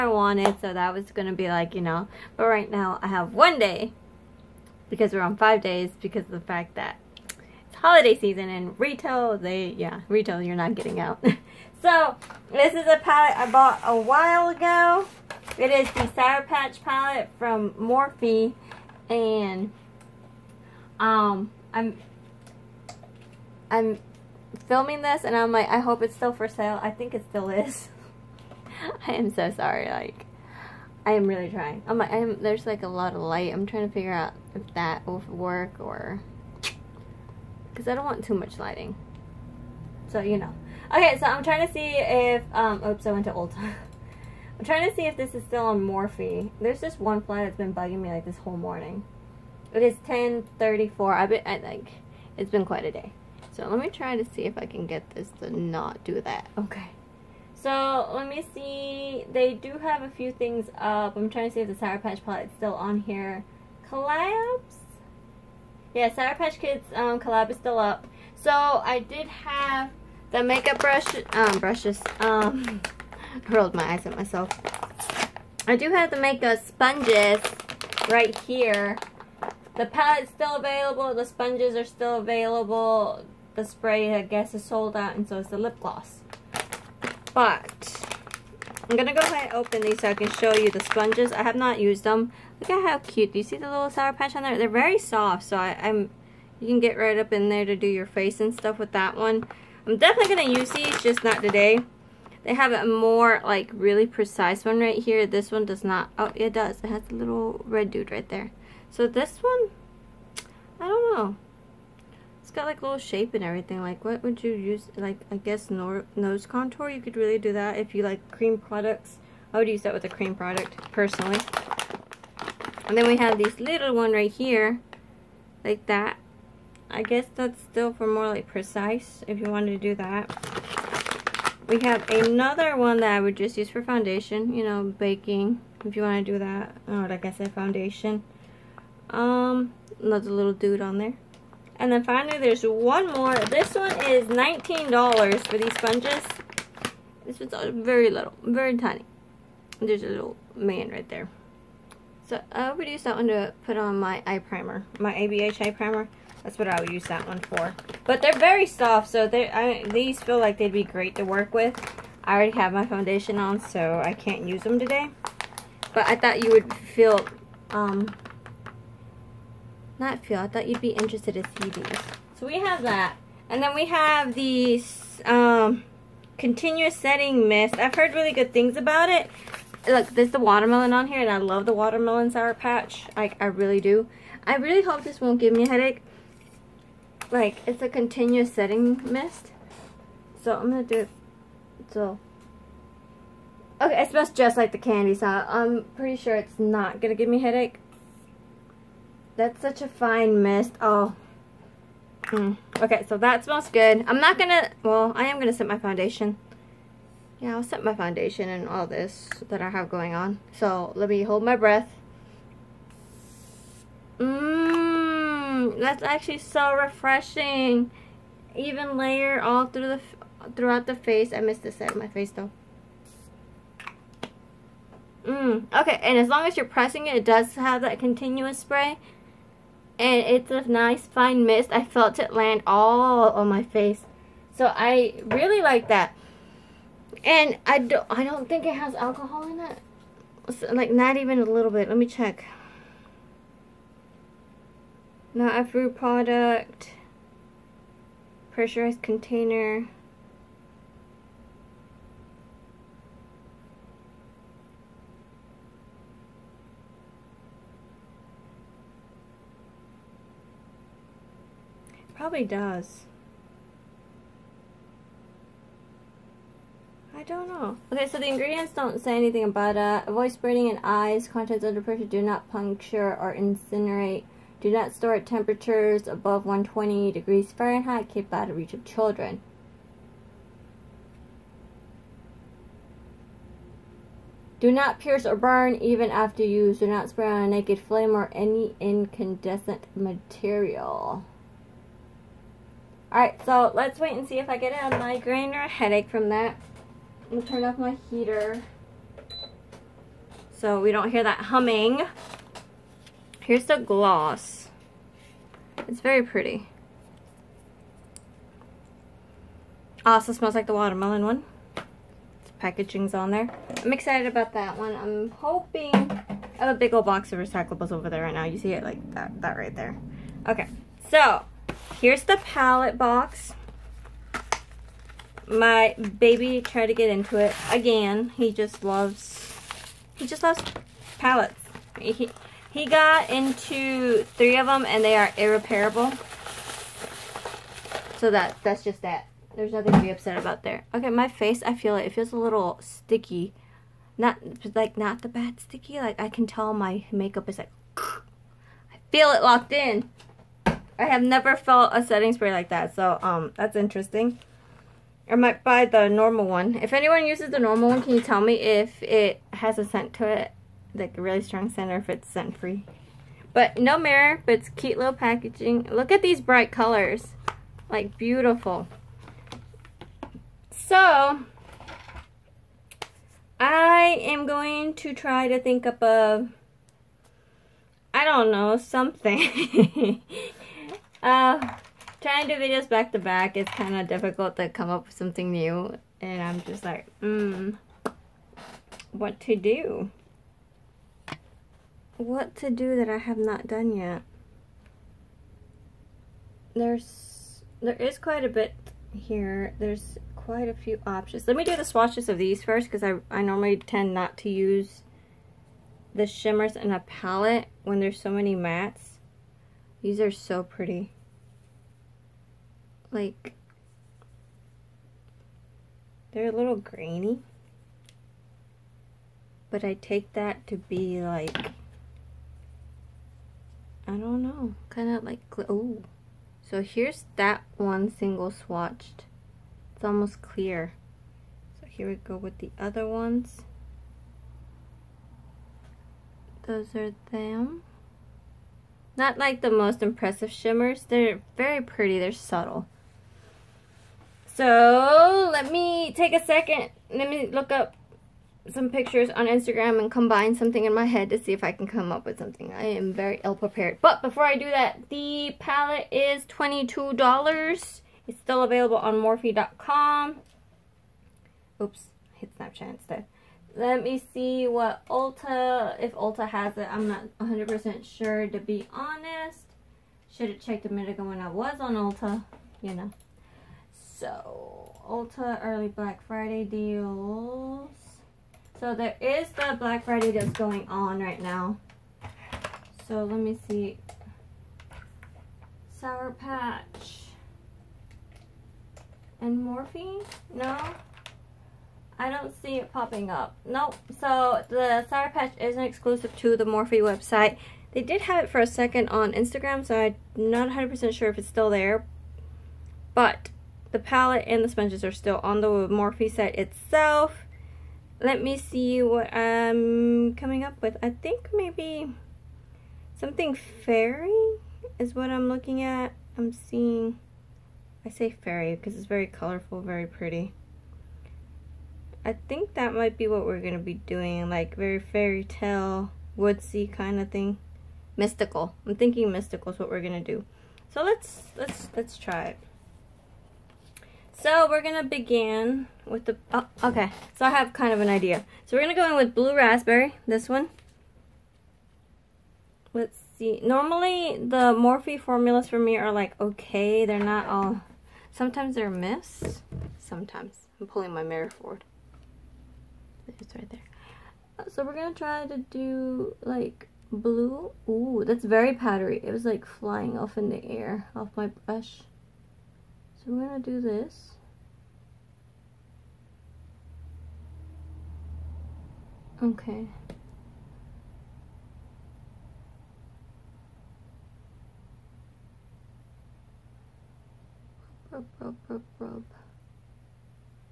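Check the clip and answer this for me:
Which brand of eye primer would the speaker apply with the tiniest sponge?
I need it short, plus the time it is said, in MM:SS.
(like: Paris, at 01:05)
ABH, at 02:35.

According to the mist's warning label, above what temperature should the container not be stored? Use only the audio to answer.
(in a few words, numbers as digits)
120 degrees Fahrenheit.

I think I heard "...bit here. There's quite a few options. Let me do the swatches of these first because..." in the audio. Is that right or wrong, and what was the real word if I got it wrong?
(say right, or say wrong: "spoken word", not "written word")
right.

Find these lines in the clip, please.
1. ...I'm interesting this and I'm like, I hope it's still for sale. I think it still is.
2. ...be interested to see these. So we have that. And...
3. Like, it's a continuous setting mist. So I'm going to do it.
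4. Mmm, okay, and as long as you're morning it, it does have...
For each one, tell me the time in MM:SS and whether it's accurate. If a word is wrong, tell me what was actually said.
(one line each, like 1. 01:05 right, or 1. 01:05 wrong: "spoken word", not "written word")
1. 00:23 wrong: "filming", not "interesting"
2. 02:50 right
3. 03:07 right
4. 03:45 wrong: "pressing", not "morning".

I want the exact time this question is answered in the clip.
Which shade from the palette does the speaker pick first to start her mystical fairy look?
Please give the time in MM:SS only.
08:59.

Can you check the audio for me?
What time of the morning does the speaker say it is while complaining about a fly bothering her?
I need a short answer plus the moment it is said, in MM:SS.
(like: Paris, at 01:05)
10:34, at 00:50.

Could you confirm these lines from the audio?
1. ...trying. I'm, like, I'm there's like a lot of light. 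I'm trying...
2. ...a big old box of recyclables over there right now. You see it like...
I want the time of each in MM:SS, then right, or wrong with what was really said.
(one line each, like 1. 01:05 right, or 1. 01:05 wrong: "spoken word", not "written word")
1. 00:31 right
2. 05:16 right.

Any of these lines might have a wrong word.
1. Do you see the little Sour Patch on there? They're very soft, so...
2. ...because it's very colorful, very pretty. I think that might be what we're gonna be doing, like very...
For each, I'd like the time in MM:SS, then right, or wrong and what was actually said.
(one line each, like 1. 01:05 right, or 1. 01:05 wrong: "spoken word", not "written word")
1. 01:33 right
2. 08:38 right.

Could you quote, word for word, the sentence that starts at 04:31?
Contents under pressure do not puncture or incinerate.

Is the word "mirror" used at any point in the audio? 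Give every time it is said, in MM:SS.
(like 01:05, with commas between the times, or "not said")
06:03, 09:11.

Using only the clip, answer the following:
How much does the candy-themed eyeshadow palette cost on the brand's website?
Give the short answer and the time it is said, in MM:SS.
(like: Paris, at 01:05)
$22, at 07:36.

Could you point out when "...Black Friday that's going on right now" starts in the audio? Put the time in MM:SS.
07:59.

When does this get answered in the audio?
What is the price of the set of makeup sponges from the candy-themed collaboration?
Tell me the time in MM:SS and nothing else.
02:24.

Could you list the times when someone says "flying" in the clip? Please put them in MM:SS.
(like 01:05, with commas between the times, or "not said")
09:19.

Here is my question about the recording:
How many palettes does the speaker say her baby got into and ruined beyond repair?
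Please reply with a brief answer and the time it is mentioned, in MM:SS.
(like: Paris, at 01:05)
3, at 05:34.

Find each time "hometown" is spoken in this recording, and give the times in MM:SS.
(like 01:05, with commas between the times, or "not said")
not said.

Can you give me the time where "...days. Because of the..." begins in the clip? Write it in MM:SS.
00:05.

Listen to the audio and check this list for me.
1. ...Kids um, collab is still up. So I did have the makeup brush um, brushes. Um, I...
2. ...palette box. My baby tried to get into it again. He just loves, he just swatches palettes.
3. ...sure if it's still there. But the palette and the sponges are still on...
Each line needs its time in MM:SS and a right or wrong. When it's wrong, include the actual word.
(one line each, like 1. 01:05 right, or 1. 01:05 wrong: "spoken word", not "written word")
1. 01:06 right
2. 05:22 wrong: "loves", not "swatches"
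3. 08:21 right.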